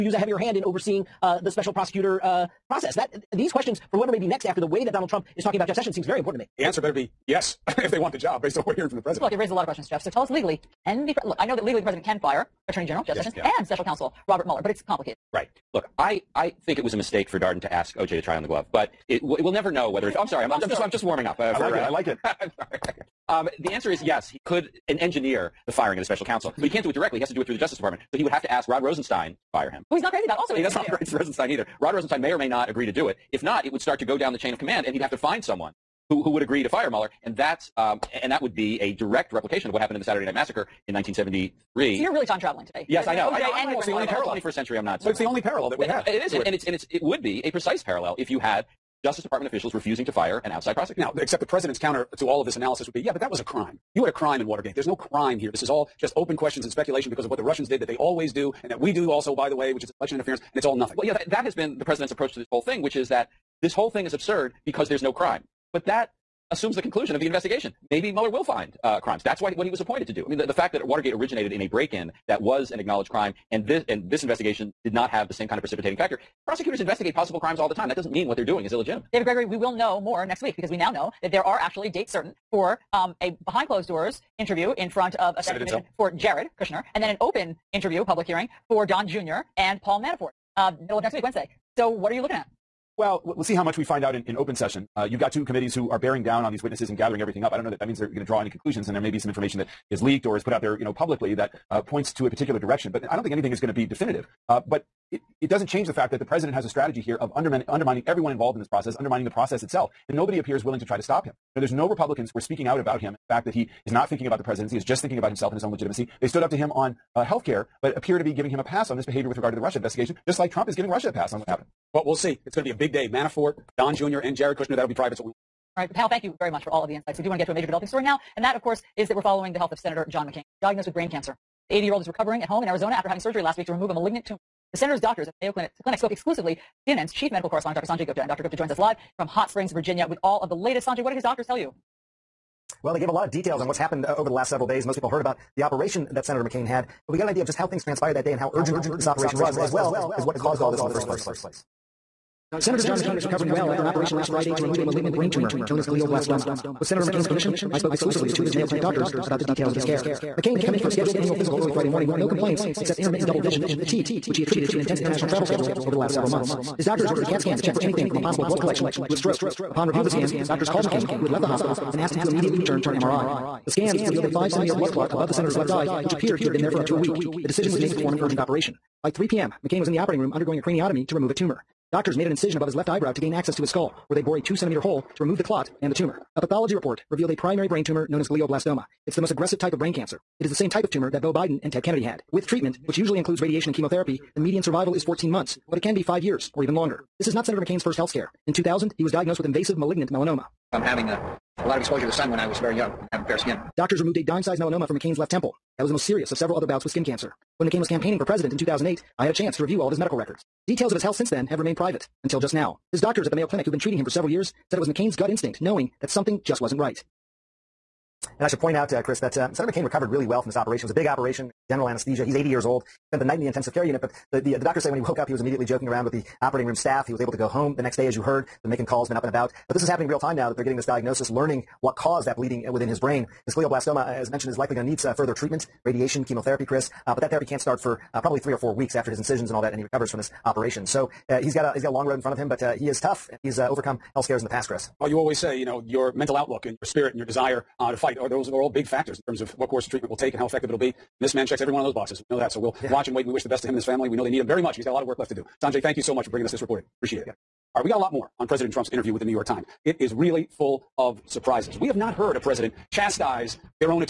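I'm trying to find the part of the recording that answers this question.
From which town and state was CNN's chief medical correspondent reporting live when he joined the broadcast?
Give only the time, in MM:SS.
02:19.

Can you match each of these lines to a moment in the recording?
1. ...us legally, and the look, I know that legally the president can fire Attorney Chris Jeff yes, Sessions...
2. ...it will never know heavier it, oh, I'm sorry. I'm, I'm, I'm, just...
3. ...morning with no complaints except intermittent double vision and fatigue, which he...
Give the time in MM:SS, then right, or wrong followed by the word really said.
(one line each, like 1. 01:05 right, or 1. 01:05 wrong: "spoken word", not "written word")
1. 00:10 wrong: "General", not "Chris"
2. 00:19 wrong: "whether", not "heavier"
3. 02:41 right.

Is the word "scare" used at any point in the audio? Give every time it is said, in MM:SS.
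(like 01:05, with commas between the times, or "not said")
03:18, 04:04.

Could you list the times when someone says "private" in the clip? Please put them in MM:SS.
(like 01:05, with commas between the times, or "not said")
02:04, 03:31.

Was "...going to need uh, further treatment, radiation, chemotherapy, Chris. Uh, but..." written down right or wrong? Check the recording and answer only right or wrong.
right.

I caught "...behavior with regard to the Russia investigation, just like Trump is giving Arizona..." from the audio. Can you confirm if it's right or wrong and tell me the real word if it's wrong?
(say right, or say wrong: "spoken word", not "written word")
wrong: "Russia", not "Arizona".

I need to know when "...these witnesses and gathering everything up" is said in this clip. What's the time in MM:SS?
01:36.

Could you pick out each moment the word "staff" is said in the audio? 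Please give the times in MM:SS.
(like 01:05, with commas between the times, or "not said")
03:46.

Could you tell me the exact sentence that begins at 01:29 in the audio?
and Paul Manafort, um, middle of next week, Wednesday.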